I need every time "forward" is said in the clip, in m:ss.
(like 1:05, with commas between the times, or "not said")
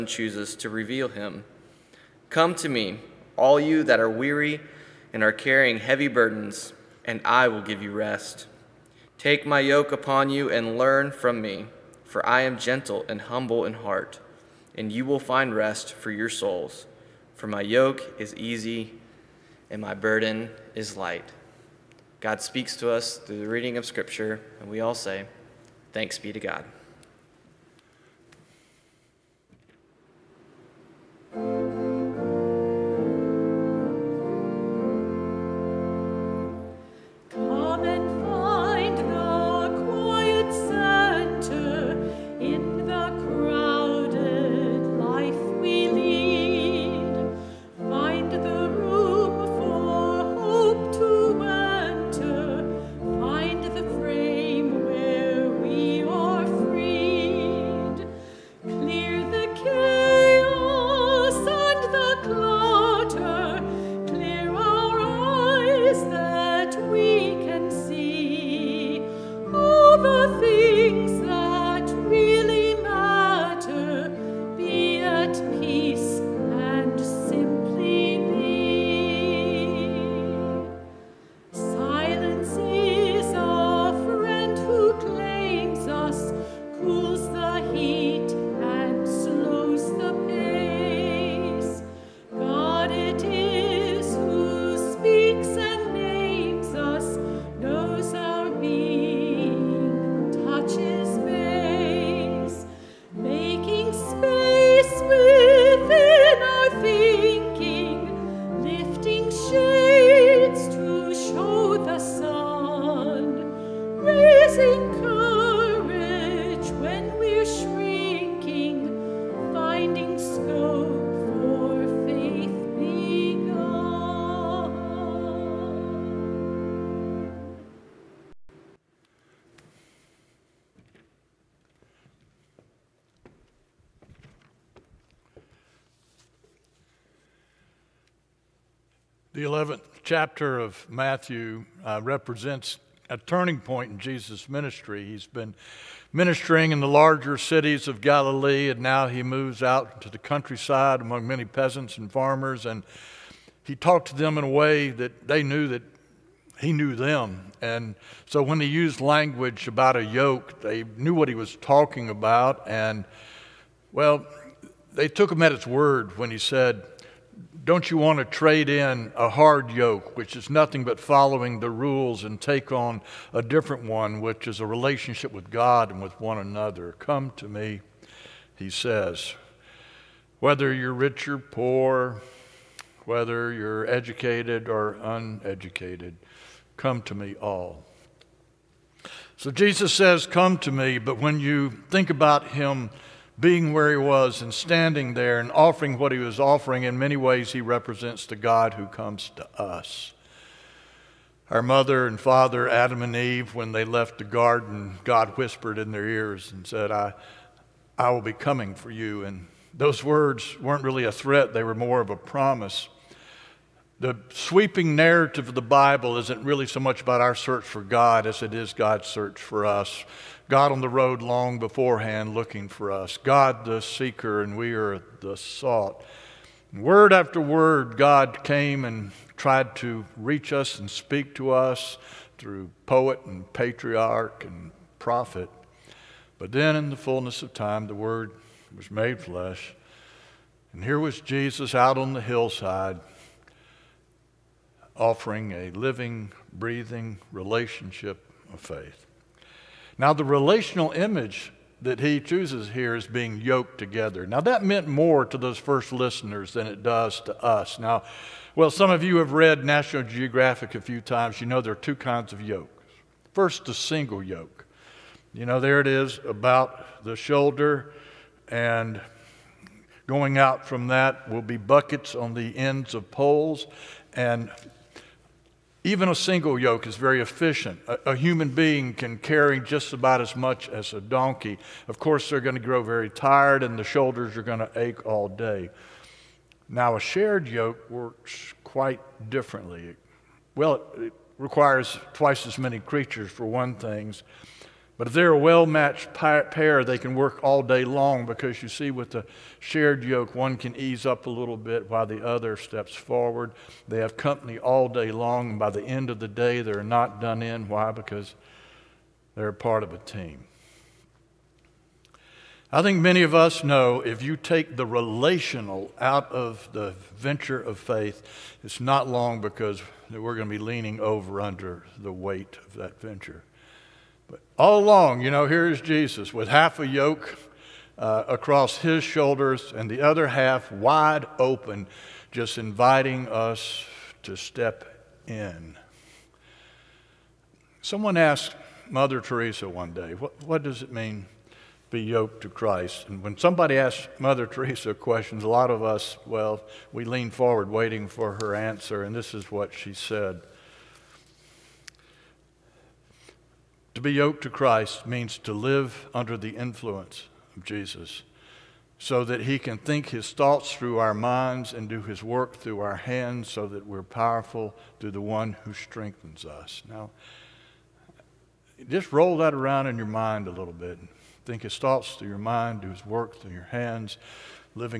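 5:02, 5:47.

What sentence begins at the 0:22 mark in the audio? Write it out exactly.
God speaks to us through the reading of Scripture, and we all say, Thanks be to God.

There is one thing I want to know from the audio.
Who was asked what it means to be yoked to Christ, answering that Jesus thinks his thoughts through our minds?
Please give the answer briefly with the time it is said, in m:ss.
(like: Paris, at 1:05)
Mother Teresa, at 5:38.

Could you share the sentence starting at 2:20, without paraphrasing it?
chapter of Matthew uh, represents a turning point in Jesus' ministry.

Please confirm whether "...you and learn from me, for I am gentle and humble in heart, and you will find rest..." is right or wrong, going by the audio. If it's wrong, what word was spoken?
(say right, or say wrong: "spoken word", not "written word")
right.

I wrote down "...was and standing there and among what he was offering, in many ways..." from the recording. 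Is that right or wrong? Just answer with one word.
wrong.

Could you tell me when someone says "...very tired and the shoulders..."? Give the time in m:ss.
4:42.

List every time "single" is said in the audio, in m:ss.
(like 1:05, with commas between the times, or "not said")
4:23, 4:36.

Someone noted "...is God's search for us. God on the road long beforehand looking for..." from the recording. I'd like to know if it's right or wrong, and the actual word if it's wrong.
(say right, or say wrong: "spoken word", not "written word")
right.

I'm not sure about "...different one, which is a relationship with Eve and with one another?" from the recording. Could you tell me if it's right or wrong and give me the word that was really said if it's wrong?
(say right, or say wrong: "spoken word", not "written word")
wrong: "God", not "Eve".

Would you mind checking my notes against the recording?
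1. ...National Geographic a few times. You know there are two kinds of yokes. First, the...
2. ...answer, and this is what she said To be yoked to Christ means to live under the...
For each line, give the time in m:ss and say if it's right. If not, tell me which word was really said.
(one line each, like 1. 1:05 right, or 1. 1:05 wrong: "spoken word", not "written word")
1. 4:19 right
2. 5:48 right.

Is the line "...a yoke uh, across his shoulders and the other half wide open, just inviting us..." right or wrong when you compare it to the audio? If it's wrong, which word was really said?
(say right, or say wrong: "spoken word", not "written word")
right.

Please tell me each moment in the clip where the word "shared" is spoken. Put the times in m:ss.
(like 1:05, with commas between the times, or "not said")
4:46, 4:59.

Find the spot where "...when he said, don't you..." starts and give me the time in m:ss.
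2:46.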